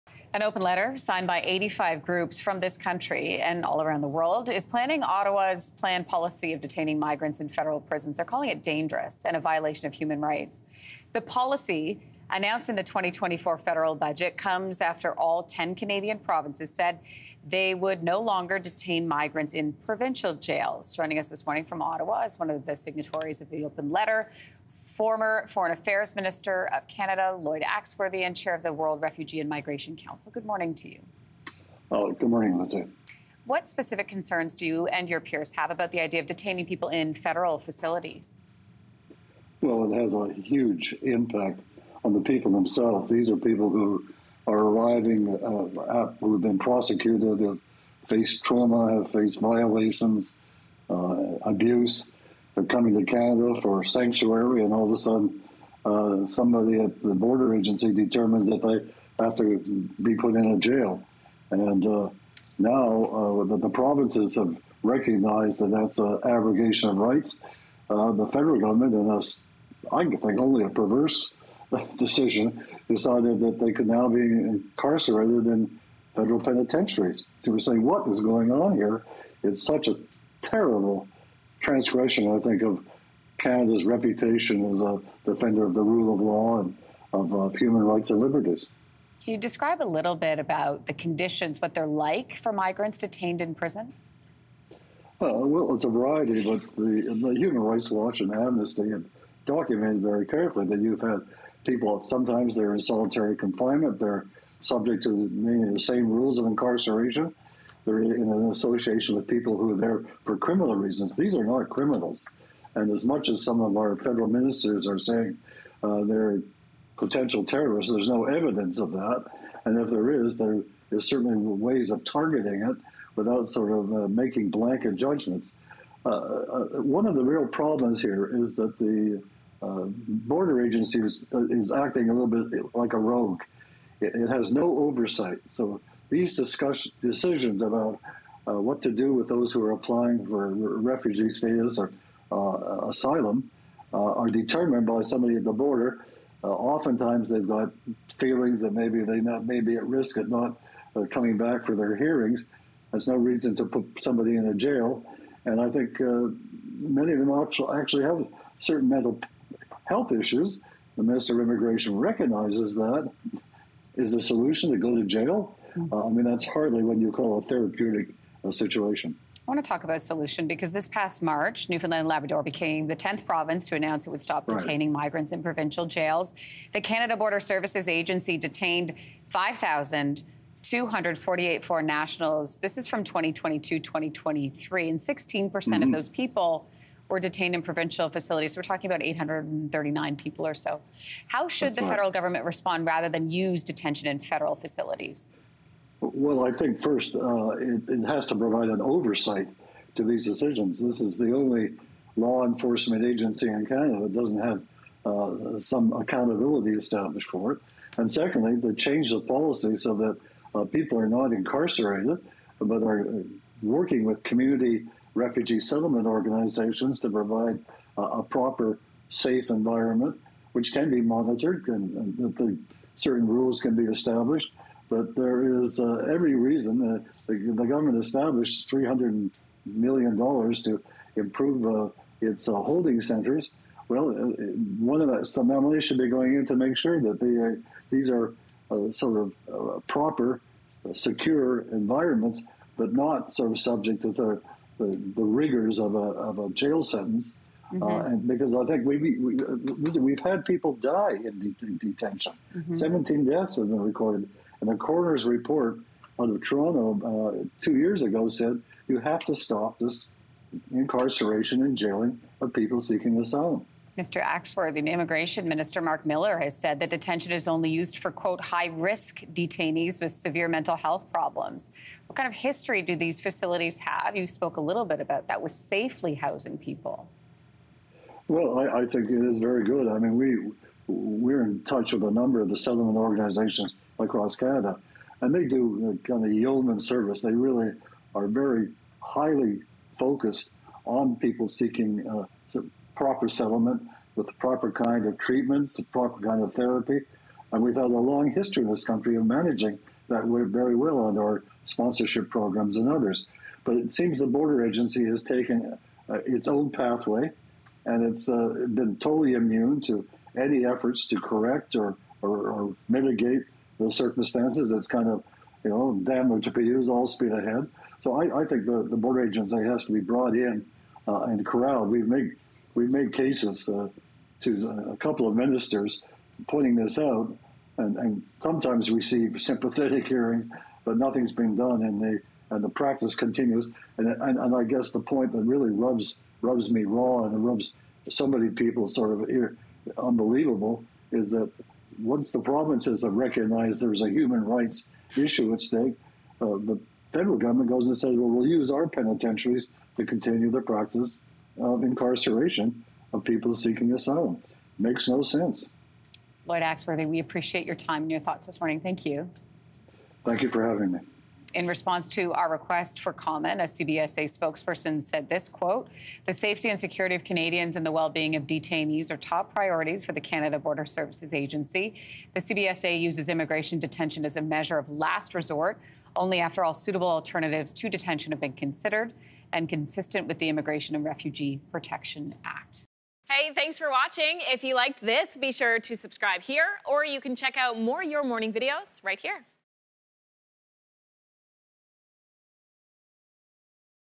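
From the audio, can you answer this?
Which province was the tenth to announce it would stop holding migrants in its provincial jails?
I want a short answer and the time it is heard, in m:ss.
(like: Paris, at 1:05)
Newfoundland and Labrador, at 2:51.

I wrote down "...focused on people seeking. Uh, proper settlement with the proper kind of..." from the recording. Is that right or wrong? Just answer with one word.
right.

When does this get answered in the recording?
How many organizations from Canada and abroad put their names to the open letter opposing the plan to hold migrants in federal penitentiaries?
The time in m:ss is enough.
0:01.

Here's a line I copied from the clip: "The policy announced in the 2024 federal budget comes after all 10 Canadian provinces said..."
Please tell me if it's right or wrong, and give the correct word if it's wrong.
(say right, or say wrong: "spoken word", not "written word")
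right.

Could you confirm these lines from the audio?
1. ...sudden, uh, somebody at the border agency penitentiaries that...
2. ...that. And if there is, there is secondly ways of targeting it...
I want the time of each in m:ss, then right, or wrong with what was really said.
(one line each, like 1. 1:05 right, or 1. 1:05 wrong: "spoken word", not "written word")
1. 0:54 wrong: "determines", not "penitentiaries"
2. 1:58 wrong: "certainly", not "secondly".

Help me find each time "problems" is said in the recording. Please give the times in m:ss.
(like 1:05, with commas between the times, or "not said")
2:07, 4:31.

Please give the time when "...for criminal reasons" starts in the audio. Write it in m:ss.
1:50.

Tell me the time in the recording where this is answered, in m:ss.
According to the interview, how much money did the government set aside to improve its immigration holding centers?
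3:48.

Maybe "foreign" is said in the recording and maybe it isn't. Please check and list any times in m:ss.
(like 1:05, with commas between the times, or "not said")
0:25, 3:01.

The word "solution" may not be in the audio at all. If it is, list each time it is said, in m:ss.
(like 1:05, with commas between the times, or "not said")
2:44, 2:50.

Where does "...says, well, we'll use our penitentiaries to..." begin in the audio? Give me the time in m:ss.
5:47.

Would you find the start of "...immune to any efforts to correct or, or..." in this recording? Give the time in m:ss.
5:09.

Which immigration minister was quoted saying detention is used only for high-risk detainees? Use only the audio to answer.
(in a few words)
Mark Miller.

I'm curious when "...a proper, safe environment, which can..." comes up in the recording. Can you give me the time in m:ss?
3:38.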